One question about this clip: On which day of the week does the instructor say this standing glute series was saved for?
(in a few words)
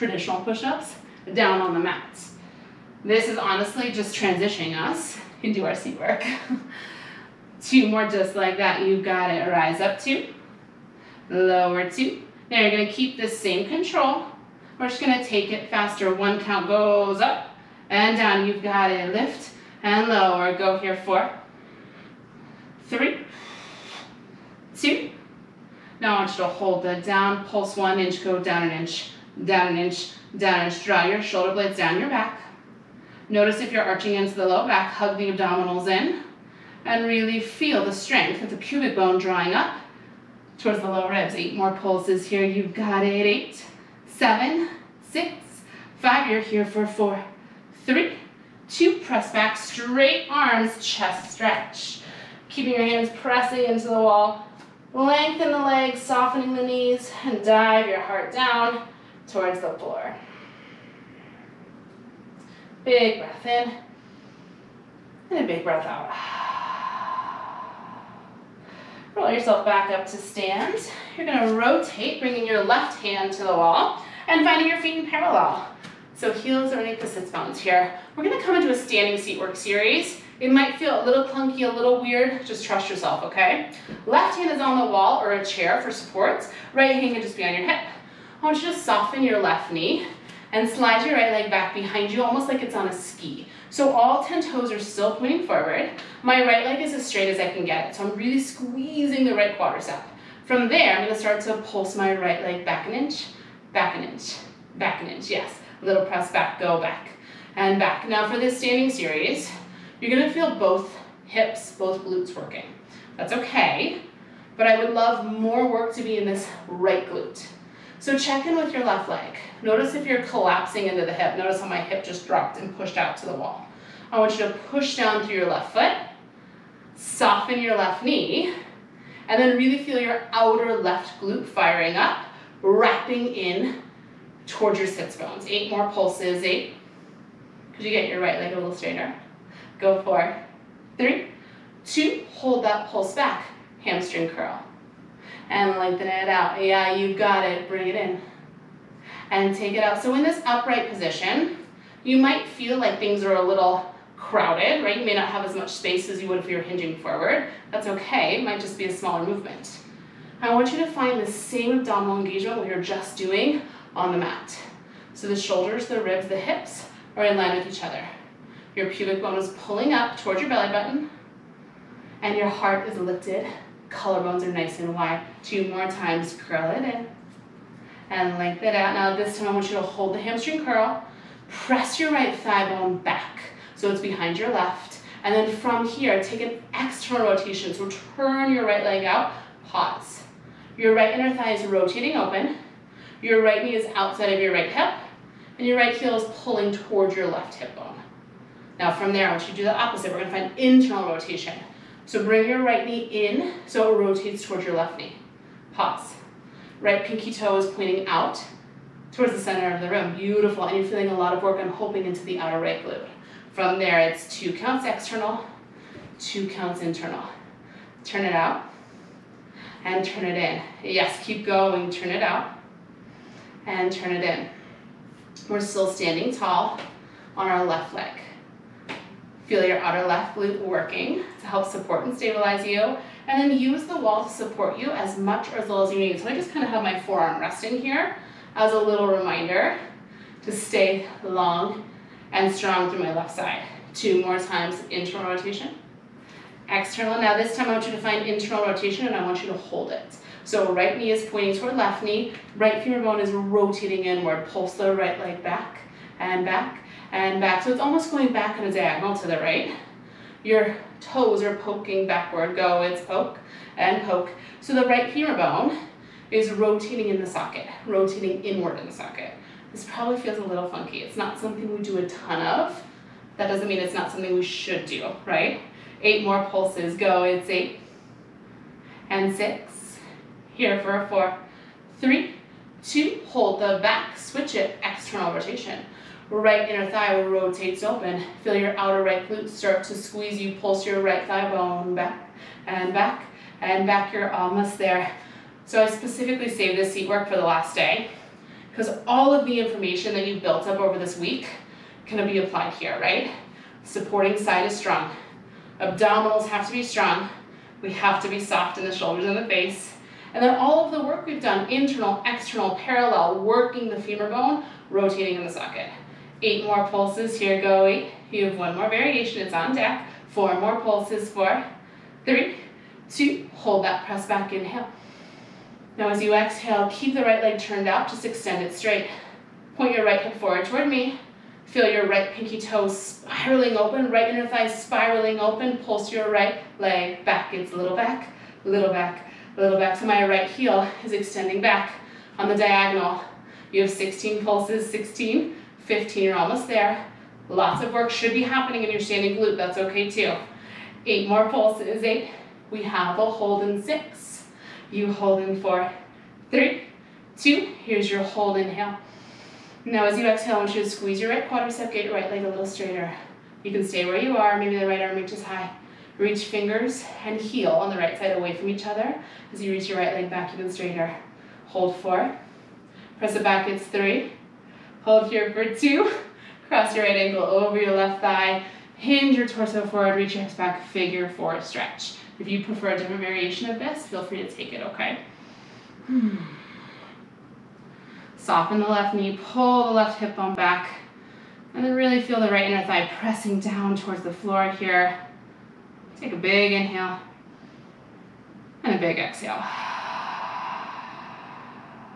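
The last day.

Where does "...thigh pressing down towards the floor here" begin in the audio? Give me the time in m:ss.
6:32.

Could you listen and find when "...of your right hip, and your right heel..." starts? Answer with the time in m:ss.
3:14.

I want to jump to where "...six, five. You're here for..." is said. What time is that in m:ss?
0:45.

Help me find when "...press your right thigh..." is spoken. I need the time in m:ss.
3:01.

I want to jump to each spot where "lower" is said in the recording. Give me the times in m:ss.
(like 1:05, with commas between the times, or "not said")
0:11, 0:20, 0:40.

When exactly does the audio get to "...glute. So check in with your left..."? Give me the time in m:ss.
1:57.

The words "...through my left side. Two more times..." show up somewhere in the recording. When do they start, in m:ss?
4:02.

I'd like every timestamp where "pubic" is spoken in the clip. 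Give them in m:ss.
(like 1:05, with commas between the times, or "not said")
0:38, 2:48.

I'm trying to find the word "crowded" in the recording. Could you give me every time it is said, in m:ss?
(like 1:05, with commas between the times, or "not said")
2:34.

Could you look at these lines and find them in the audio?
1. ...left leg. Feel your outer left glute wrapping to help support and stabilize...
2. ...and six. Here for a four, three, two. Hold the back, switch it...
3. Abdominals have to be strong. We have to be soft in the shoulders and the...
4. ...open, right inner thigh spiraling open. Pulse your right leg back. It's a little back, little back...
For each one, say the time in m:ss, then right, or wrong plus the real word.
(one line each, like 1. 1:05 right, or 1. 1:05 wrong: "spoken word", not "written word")
1. 3:47 wrong: "working", not "wrapping"
2. 4:39 right
3. 5:05 right
4. 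5:33 right.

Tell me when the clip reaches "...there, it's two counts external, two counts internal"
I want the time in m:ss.
3:33.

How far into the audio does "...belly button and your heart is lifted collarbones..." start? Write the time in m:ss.
2:50.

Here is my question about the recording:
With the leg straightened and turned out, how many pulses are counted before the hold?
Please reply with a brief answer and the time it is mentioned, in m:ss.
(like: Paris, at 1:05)
16, at 5:43.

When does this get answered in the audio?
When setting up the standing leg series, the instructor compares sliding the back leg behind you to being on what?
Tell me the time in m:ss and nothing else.
1:32.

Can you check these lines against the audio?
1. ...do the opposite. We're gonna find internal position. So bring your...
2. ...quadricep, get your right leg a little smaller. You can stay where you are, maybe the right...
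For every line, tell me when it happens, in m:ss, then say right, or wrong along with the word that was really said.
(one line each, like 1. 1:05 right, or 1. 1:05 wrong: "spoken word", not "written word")
1. 3:19 wrong: "rotation", not "position"
2. 6:01 wrong: "straighter", not "smaller".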